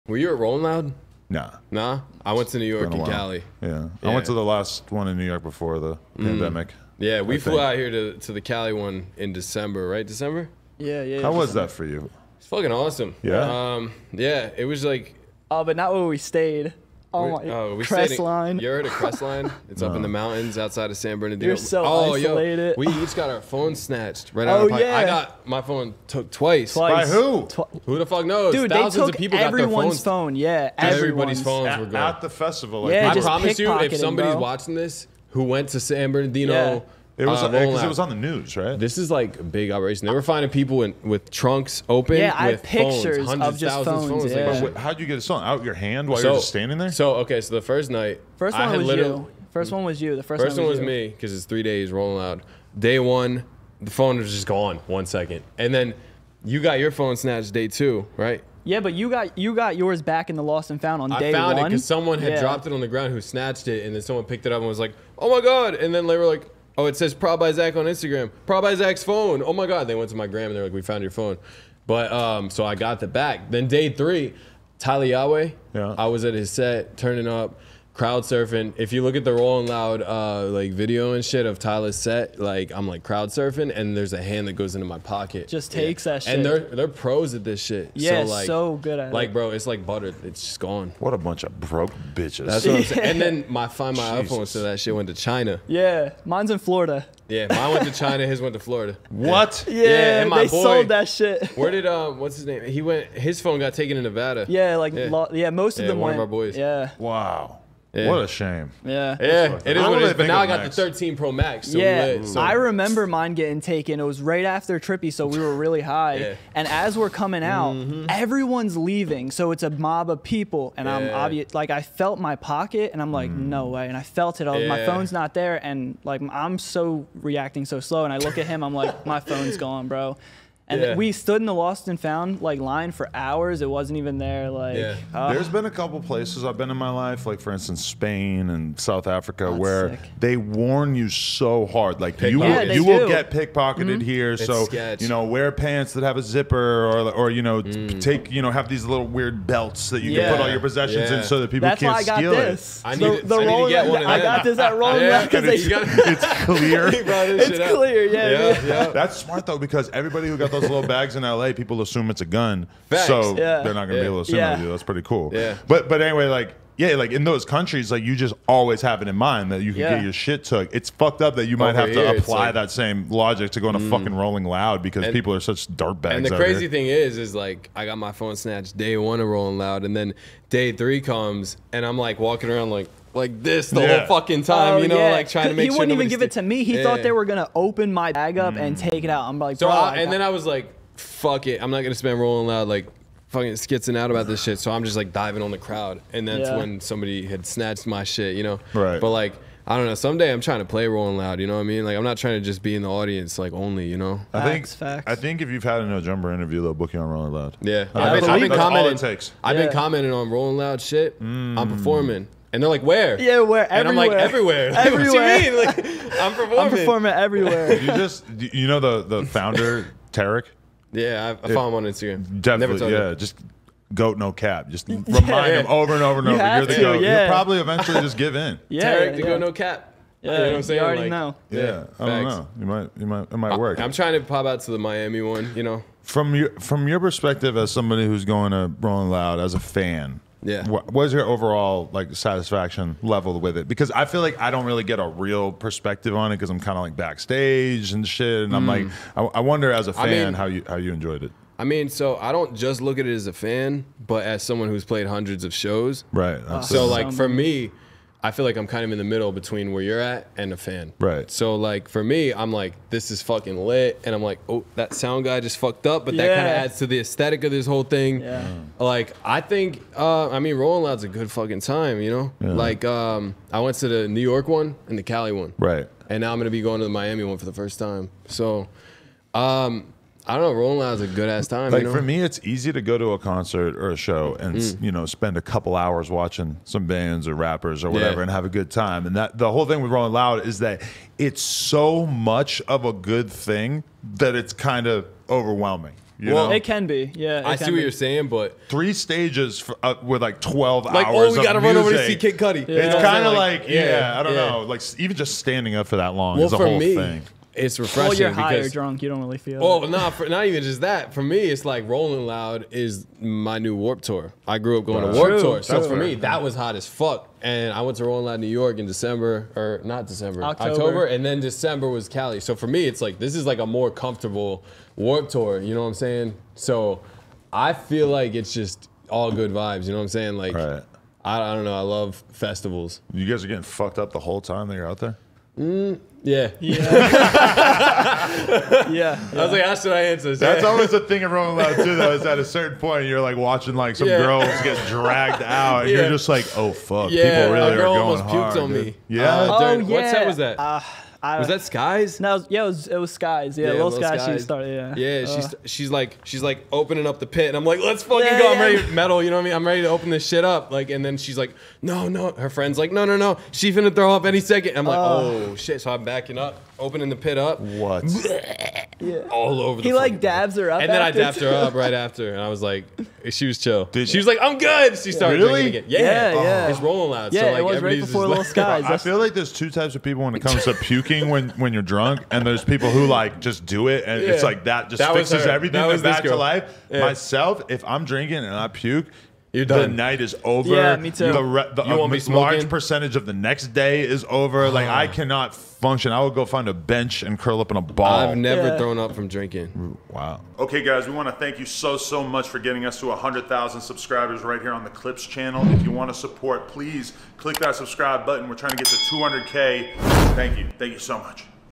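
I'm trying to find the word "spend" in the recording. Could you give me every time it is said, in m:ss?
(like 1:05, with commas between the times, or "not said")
3:11, 4:45.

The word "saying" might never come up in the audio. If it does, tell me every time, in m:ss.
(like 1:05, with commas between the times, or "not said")
1:32, 3:50, 4:57, 5:25, 5:30.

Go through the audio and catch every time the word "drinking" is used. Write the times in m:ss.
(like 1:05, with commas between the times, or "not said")
6:15, 6:21, 6:28, 6:39.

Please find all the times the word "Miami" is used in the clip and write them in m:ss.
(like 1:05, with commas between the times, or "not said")
3:54, 4:36.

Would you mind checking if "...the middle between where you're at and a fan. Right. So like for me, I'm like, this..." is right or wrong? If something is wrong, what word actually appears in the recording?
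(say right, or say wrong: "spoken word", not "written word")
right.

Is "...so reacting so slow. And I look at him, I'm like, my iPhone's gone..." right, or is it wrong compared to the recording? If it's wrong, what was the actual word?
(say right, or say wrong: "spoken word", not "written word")
wrong: "phone", not "iPhone".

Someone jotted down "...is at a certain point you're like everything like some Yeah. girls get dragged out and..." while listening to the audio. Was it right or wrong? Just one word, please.
wrong.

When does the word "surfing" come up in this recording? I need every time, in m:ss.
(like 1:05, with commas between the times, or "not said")
1:18, 1:23.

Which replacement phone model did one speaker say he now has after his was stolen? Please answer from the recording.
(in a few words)
13 Pro Max.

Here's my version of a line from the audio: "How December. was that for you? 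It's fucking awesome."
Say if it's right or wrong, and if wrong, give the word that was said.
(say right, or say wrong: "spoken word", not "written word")
right.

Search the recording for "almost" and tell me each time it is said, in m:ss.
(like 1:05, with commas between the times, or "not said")
5:48.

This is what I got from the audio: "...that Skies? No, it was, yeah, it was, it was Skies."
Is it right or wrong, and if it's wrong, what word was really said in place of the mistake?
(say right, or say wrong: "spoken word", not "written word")
right.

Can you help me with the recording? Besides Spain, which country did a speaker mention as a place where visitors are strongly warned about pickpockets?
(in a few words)
South Africa.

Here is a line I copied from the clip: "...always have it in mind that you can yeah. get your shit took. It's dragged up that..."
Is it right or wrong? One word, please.
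wrong.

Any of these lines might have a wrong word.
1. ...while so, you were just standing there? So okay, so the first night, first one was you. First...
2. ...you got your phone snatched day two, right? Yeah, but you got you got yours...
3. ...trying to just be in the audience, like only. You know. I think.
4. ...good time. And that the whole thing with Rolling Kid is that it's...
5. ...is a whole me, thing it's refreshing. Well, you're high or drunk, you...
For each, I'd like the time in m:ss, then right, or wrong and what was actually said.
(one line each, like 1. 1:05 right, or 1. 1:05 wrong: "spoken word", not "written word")
1. 0:46 right
2. 0:56 right
3. 3:22 right
4. 4:48 wrong: "Loud", not "Kid"
5. 5:06 right.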